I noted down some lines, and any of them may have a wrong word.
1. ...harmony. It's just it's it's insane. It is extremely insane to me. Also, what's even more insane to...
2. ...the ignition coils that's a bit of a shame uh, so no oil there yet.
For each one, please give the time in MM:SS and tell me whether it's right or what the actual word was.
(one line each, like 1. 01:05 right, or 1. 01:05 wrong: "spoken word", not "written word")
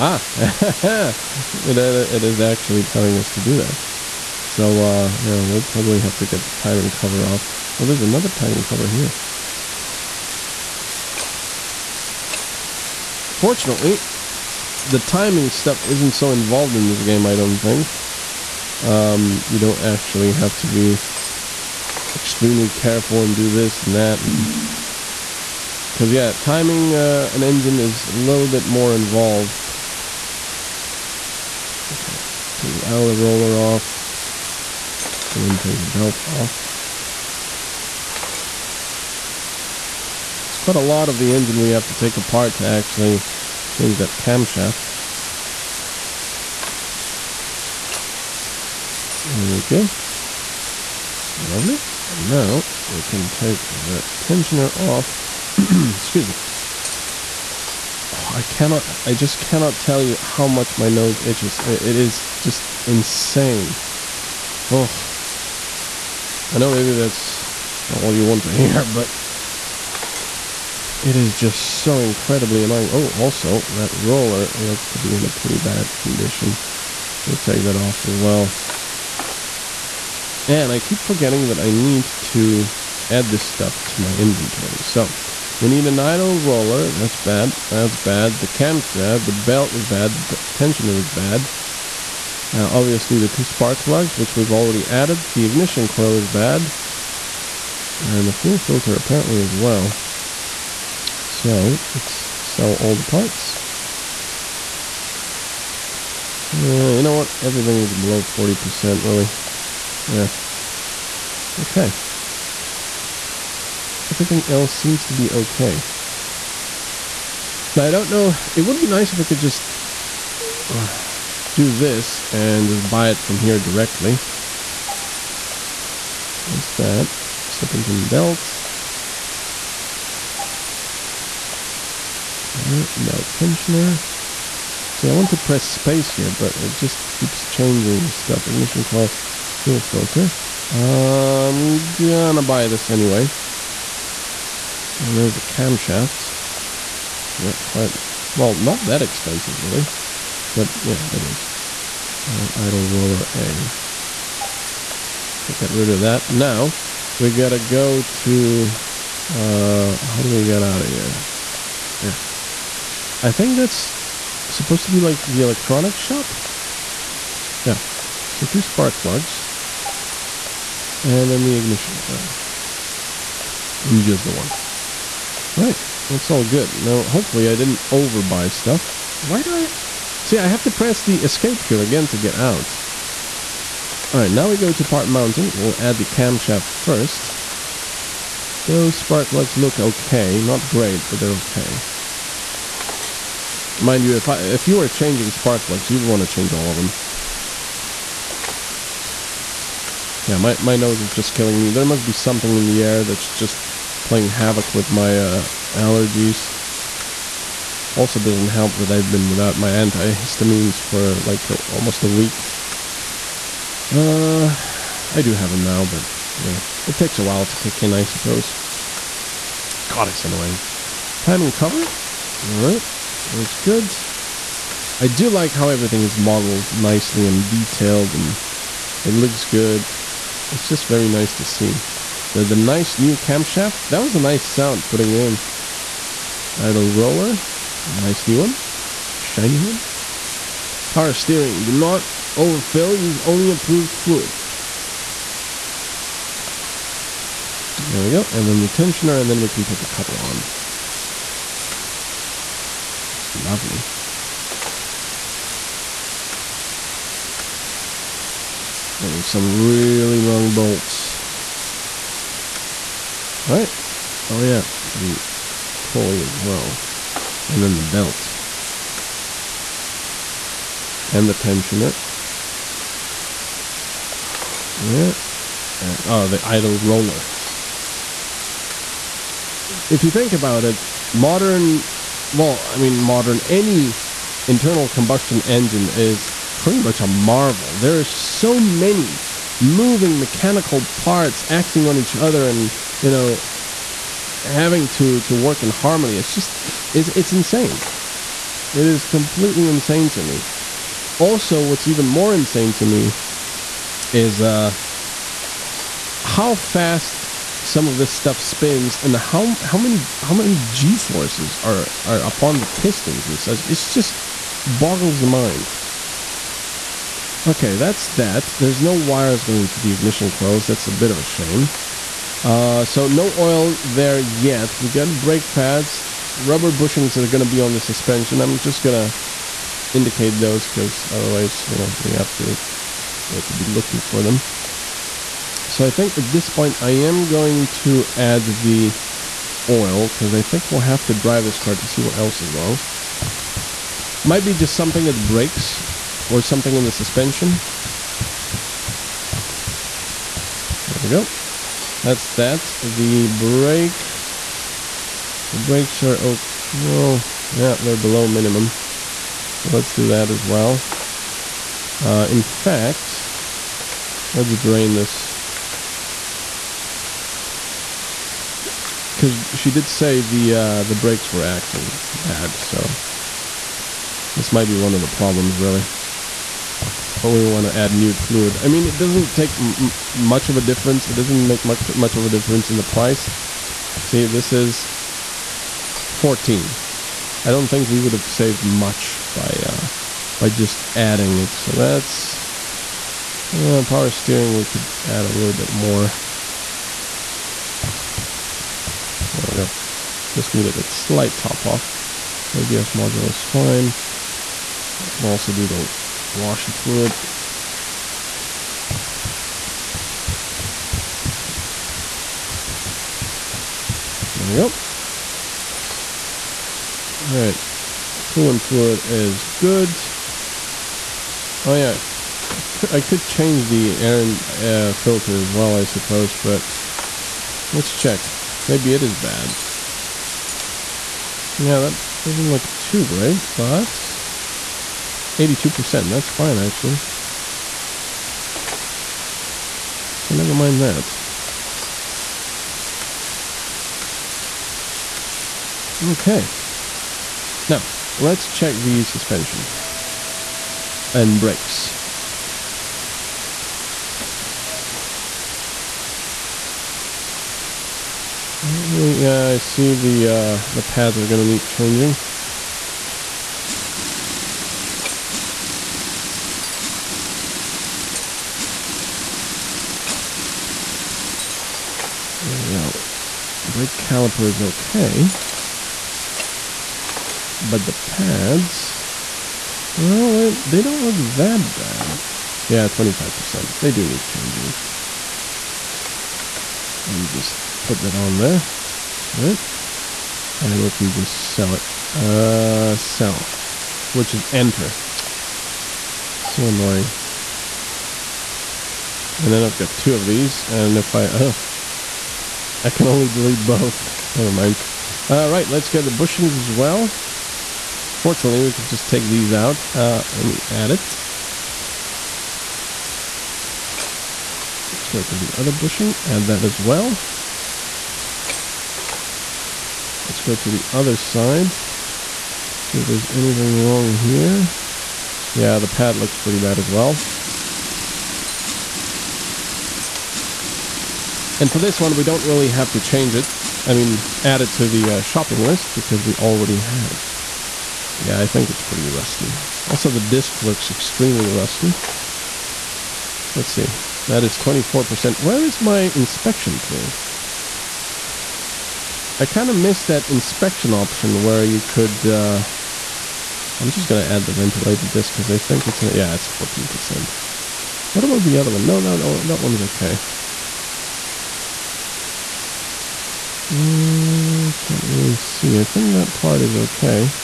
1. 04:55 wrong: "completely", not "extremely"
2. 05:19 right.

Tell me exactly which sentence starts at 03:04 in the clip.
Alright, now we go to part mounting.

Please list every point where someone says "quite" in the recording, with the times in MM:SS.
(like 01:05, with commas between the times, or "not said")
00:40, 02:27.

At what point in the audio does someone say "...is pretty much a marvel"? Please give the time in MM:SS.
04:45.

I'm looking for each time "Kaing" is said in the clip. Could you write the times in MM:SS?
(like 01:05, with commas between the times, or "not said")
not said.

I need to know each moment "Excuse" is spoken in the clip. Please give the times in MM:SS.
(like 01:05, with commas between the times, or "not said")
00:55.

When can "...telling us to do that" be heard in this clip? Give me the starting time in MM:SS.
00:02.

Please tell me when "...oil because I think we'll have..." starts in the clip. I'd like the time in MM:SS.
05:39.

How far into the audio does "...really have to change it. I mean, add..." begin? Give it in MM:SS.
08:52.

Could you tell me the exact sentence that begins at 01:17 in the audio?
We'll take that off as well.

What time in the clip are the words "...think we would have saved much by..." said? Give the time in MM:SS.
06:27.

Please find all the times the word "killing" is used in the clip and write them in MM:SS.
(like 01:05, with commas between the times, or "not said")
03:21.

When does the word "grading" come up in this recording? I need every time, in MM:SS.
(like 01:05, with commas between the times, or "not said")
not said.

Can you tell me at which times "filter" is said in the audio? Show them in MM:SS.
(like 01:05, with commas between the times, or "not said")
01:38, 02:19, 07:04.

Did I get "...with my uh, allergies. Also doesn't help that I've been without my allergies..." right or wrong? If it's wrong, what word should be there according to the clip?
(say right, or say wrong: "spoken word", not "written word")
wrong: "antihistamines", not "allergies".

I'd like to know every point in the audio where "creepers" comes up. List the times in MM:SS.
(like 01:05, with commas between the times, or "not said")
not said.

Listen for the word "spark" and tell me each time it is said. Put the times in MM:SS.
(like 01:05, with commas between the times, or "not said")
01:33, 02:48, 03:08, 03:15.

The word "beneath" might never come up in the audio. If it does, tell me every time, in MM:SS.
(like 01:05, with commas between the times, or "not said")
not said.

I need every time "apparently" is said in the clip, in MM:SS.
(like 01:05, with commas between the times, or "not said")
01:38.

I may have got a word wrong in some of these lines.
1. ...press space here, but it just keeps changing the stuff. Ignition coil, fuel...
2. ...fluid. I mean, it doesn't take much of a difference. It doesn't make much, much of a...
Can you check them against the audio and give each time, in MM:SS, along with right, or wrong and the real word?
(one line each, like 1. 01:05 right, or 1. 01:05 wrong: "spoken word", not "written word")
1. 02:15 right
2. 06:18 right.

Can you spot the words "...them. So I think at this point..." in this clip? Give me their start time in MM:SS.
05:34.